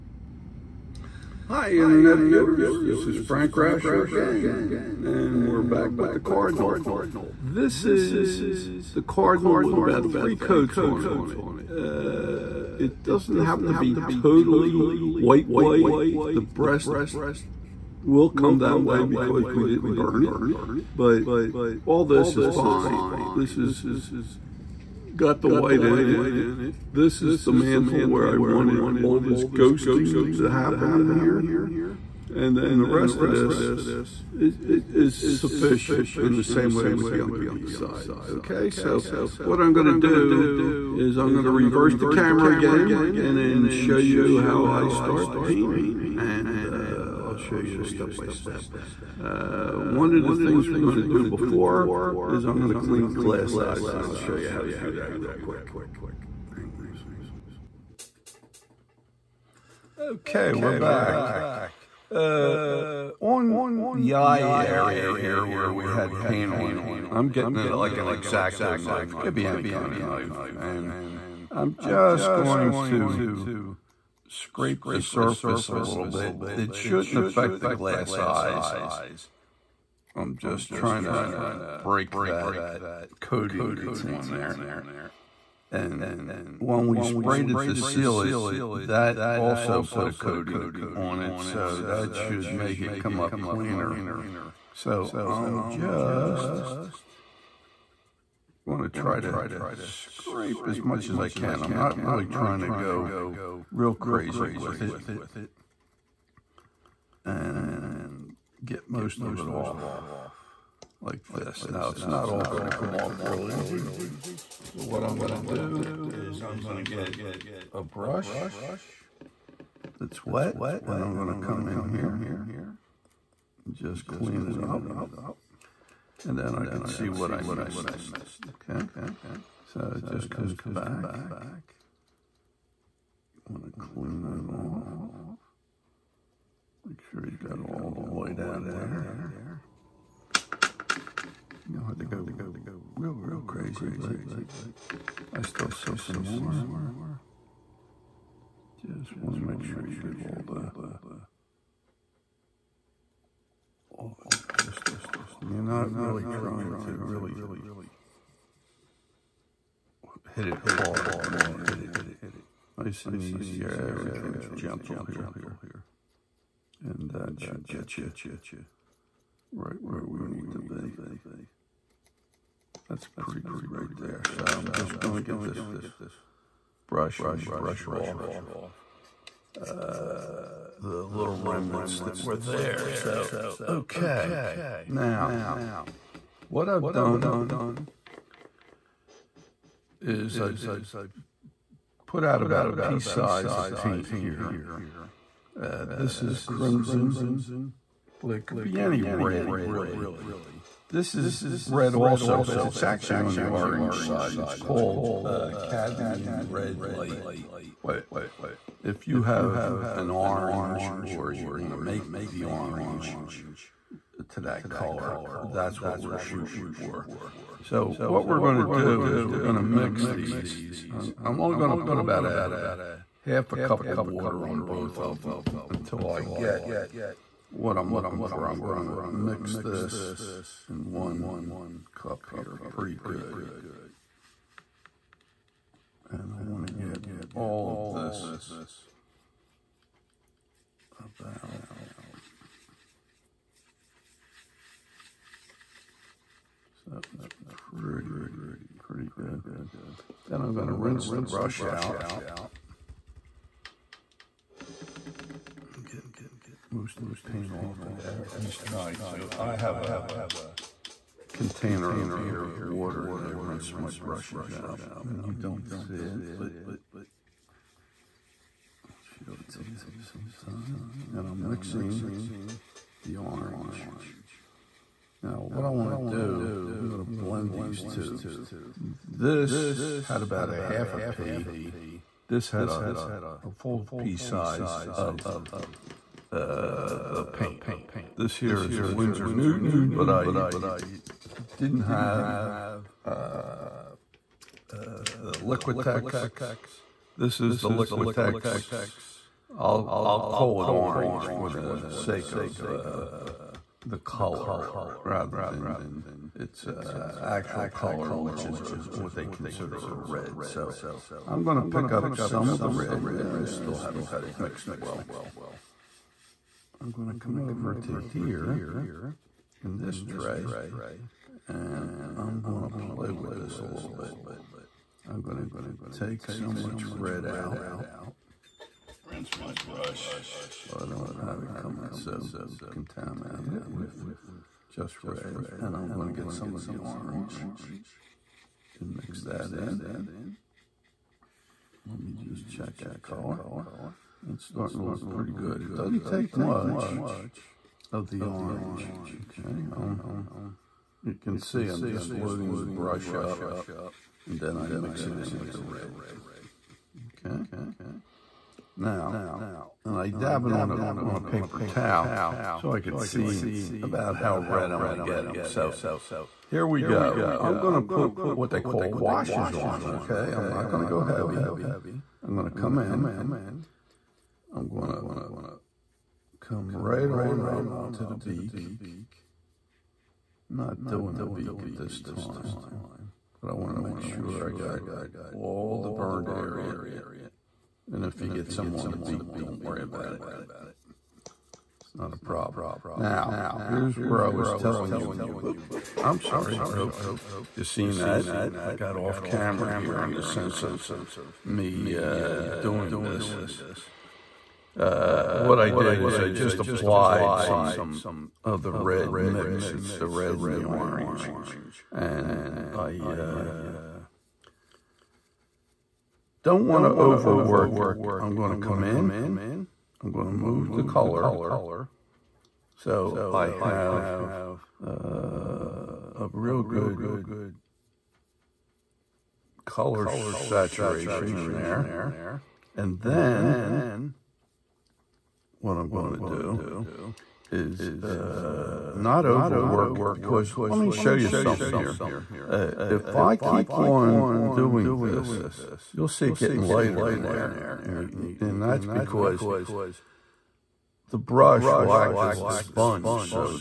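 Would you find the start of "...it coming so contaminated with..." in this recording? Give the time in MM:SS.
05:31.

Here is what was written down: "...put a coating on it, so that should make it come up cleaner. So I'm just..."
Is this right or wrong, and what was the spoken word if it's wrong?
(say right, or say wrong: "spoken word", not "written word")
right.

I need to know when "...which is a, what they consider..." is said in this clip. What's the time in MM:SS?
05:08.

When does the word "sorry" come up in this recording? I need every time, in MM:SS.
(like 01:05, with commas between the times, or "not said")
06:36.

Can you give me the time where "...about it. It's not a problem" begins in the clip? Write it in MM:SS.
06:29.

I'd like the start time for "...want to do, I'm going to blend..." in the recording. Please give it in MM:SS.
04:35.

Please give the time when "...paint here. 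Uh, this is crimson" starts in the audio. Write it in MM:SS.
03:13.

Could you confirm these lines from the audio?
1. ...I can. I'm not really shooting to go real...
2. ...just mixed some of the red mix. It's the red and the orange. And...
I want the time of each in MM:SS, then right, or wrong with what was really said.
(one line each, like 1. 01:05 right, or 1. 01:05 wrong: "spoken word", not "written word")
1. 01:41 wrong: "trying", not "shooting"
2. 06:46 wrong: "applied", not "mixed".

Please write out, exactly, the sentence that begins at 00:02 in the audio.
This is Frank Rauscher again, and we're back with the Cardinal.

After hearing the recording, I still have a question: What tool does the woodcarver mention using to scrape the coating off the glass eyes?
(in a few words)
X-Acto knife.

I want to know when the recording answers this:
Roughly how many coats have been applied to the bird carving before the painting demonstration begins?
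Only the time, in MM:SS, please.
00:10.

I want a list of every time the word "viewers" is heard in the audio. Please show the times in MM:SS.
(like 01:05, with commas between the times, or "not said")
00:02.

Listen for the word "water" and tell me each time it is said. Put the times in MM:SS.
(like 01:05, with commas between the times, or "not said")
03:43, 04:22.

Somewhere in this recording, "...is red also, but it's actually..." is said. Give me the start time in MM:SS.
03:21.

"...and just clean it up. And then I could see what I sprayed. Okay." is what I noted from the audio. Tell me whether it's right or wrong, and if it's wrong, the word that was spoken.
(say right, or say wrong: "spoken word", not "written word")
wrong: "missed", not "sprayed".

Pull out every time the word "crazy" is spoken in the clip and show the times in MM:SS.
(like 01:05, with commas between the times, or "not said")
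01:43, 02:23.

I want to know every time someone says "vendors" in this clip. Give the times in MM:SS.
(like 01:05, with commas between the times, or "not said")
not said.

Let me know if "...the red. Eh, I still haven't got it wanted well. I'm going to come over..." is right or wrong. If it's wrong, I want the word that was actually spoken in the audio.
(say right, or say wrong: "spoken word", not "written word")
wrong: "mixed", not "wanted".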